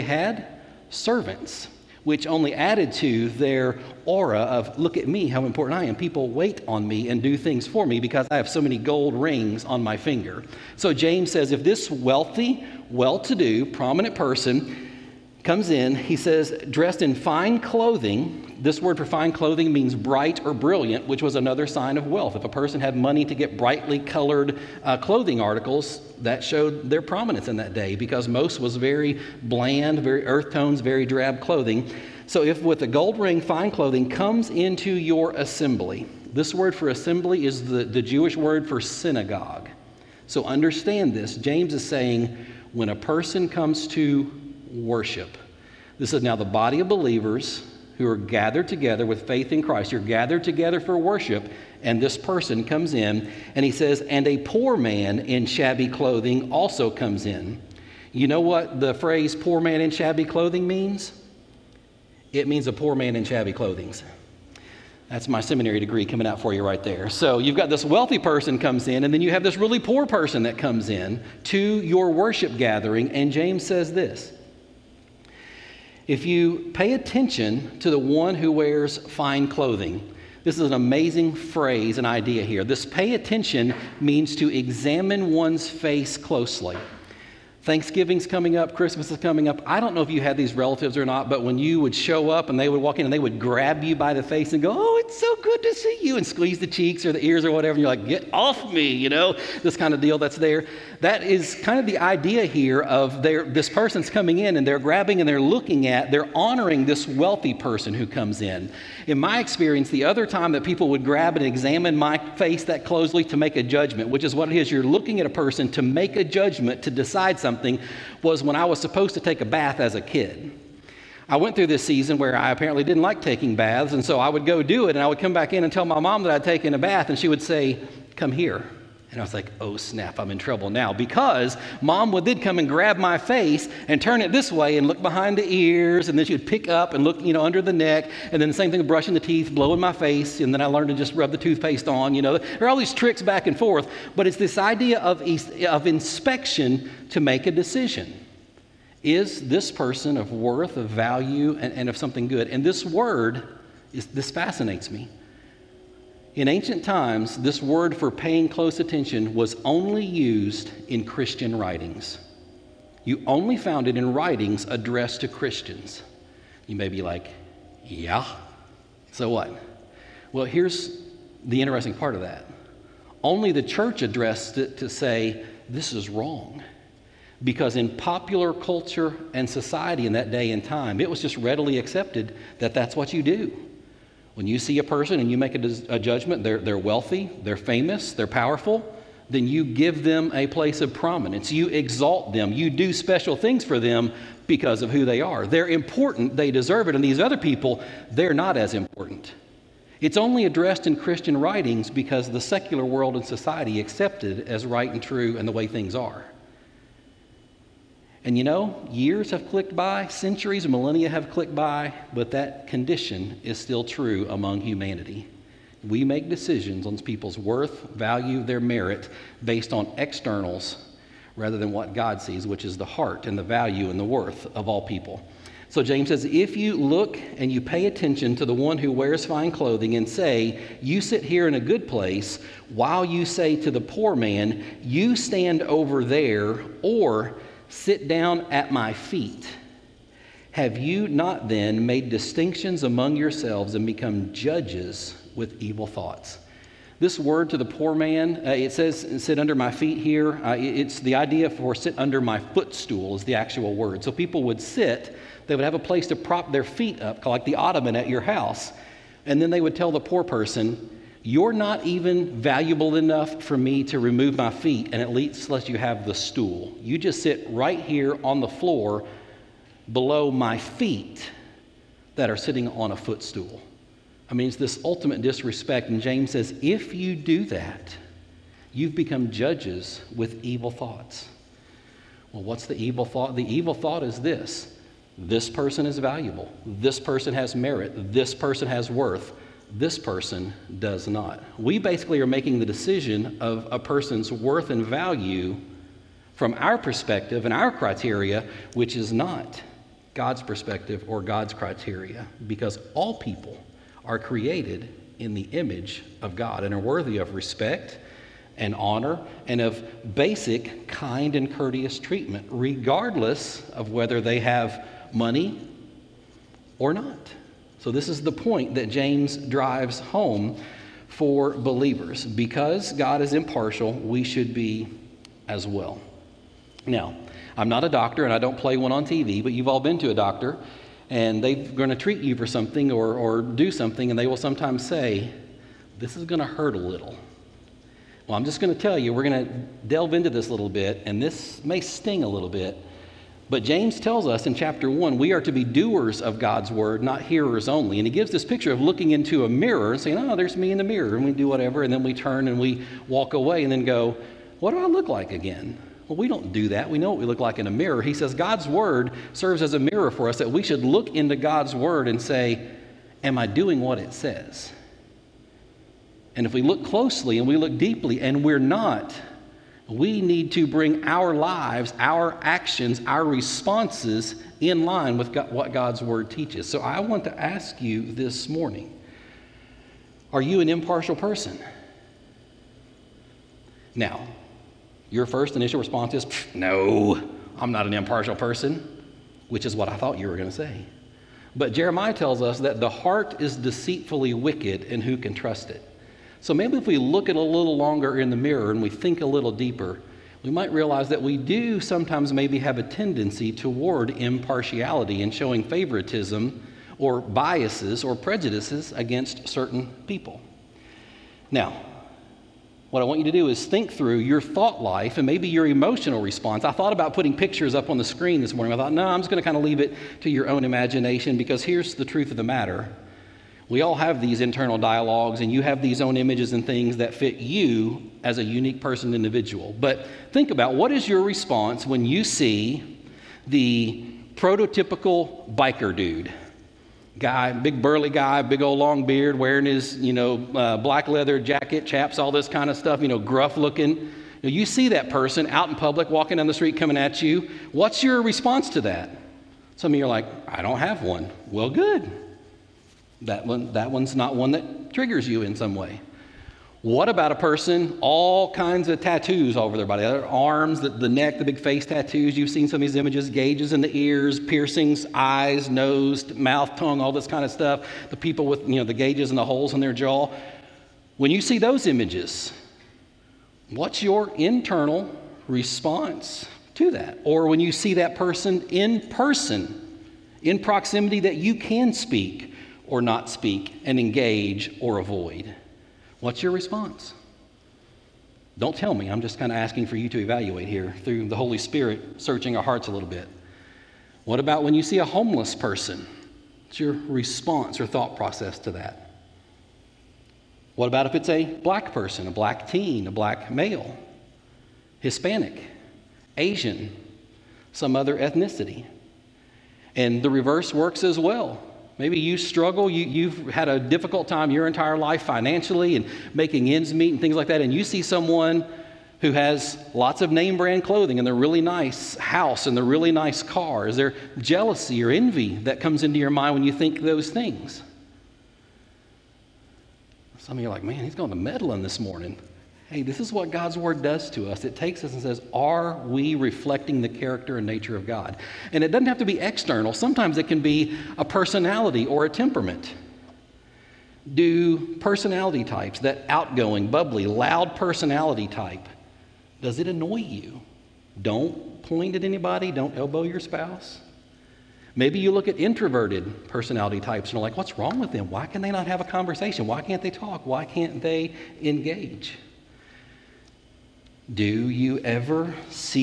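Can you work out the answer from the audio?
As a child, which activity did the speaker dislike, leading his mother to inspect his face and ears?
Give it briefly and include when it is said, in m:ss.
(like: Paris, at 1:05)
taking baths, at 2:03.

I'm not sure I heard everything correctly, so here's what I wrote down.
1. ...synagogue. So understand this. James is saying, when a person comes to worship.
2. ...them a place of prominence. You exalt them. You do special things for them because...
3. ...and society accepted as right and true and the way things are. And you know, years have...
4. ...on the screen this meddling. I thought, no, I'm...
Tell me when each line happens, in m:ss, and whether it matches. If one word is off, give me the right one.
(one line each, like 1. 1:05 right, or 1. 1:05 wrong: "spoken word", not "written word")
1. 0:38 right
2. 3:10 right
3. 3:23 right
4. 6:57 wrong: "morning", not "meddling".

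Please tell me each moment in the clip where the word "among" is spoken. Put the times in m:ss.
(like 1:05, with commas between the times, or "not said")
3:34, 4:02.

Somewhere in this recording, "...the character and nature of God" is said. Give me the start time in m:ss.
8:57.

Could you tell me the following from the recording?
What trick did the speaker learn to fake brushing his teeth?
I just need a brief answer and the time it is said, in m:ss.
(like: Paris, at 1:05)
rub the toothpaste on, at 2:21.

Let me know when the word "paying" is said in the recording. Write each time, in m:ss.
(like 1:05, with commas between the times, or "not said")
2:38.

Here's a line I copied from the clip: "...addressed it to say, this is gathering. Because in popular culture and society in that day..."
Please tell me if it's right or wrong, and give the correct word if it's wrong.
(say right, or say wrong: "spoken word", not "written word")
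wrong: "wrong", not "gathering".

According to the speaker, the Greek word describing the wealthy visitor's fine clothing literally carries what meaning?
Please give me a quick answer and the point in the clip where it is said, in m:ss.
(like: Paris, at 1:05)
bright or brilliant, at 0:19.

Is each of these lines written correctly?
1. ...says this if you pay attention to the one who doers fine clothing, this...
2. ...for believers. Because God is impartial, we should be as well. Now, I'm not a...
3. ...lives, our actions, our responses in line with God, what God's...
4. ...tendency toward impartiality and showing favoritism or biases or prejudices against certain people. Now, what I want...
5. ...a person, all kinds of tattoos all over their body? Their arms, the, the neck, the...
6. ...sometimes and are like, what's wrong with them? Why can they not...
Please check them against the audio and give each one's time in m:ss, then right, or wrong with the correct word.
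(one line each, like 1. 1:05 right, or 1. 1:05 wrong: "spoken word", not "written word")
1. 1:13 wrong: "wears", not "doers"
2. 5:21 right
3. 6:11 right
4. 6:42 right
5. 7:37 right
6. 9:16 wrong: "types", not "sometimes".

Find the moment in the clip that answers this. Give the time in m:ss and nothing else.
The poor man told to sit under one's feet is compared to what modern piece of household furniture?
4:17.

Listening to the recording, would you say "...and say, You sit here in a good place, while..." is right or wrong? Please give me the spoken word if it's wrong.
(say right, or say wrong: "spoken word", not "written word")
right.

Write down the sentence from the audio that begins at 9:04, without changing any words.
Do personality types, that outgoing, bubbly, loud personality type, does it annoy you?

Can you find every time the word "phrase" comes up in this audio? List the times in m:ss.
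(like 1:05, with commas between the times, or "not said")
0:58, 1:21.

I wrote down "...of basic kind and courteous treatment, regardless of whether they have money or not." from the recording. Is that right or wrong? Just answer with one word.
right.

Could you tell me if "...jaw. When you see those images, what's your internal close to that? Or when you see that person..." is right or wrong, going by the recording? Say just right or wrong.
wrong.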